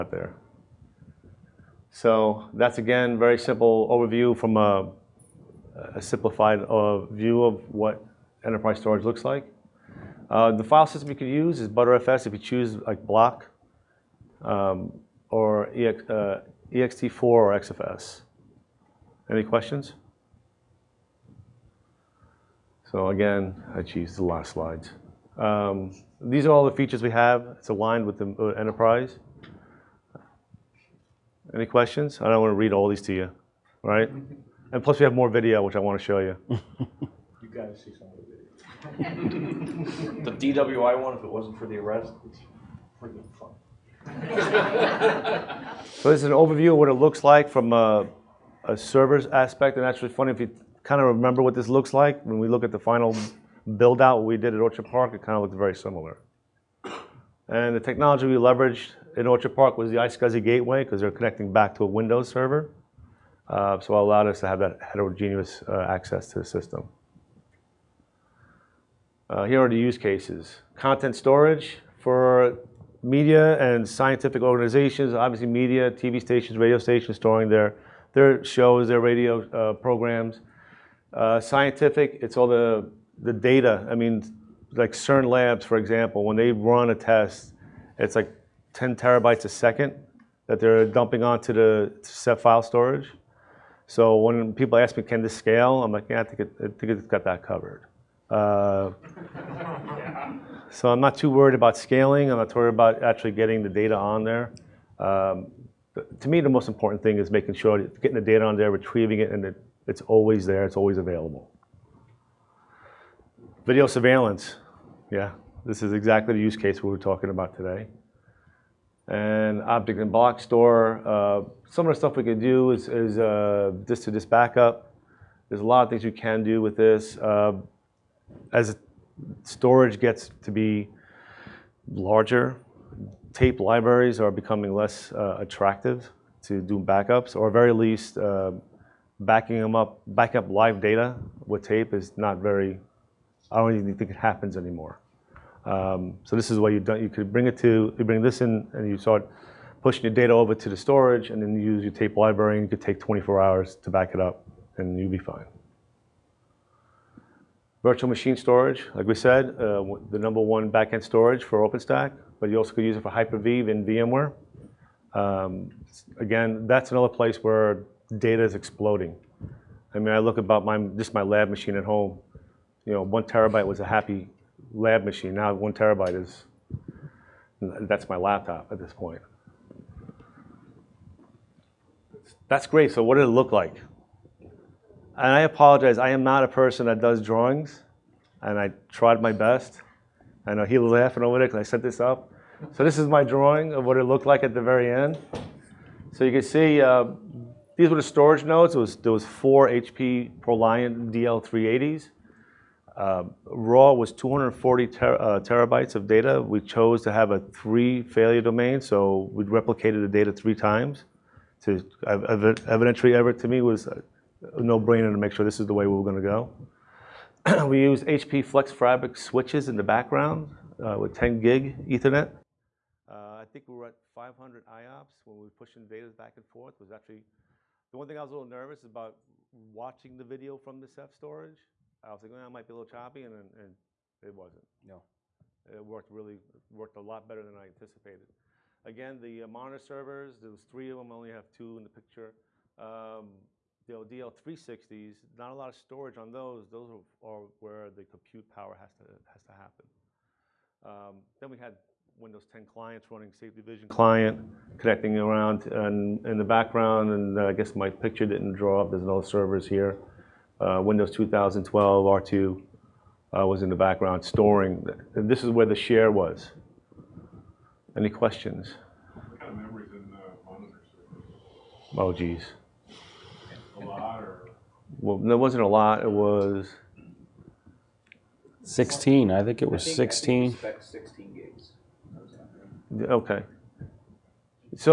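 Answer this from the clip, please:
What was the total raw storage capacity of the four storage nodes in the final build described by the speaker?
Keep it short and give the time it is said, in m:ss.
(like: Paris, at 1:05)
240 terabytes, at 3:24.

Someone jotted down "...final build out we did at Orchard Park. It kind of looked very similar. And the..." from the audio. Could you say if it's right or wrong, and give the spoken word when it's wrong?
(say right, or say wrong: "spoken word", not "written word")
right.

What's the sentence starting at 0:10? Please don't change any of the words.
Uh, the file system you could use is Btrfs if you choose like block um, or EX, uh, ext4 or XFS.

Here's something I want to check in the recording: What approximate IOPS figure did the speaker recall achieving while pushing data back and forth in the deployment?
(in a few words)
500.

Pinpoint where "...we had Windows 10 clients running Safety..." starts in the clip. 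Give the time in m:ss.
4:11.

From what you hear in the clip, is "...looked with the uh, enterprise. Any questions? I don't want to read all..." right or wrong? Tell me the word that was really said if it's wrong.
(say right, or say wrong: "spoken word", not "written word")
wrong: "aligned", not "looked".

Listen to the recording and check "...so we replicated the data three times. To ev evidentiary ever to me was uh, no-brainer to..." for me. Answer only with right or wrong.
right.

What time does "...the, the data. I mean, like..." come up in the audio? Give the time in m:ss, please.
1:22.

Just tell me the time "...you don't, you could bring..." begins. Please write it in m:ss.
2:26.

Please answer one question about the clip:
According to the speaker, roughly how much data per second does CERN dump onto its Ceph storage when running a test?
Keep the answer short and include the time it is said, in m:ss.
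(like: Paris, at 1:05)
10 terabytes, at 1:28.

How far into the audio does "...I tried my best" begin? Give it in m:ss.
3:08.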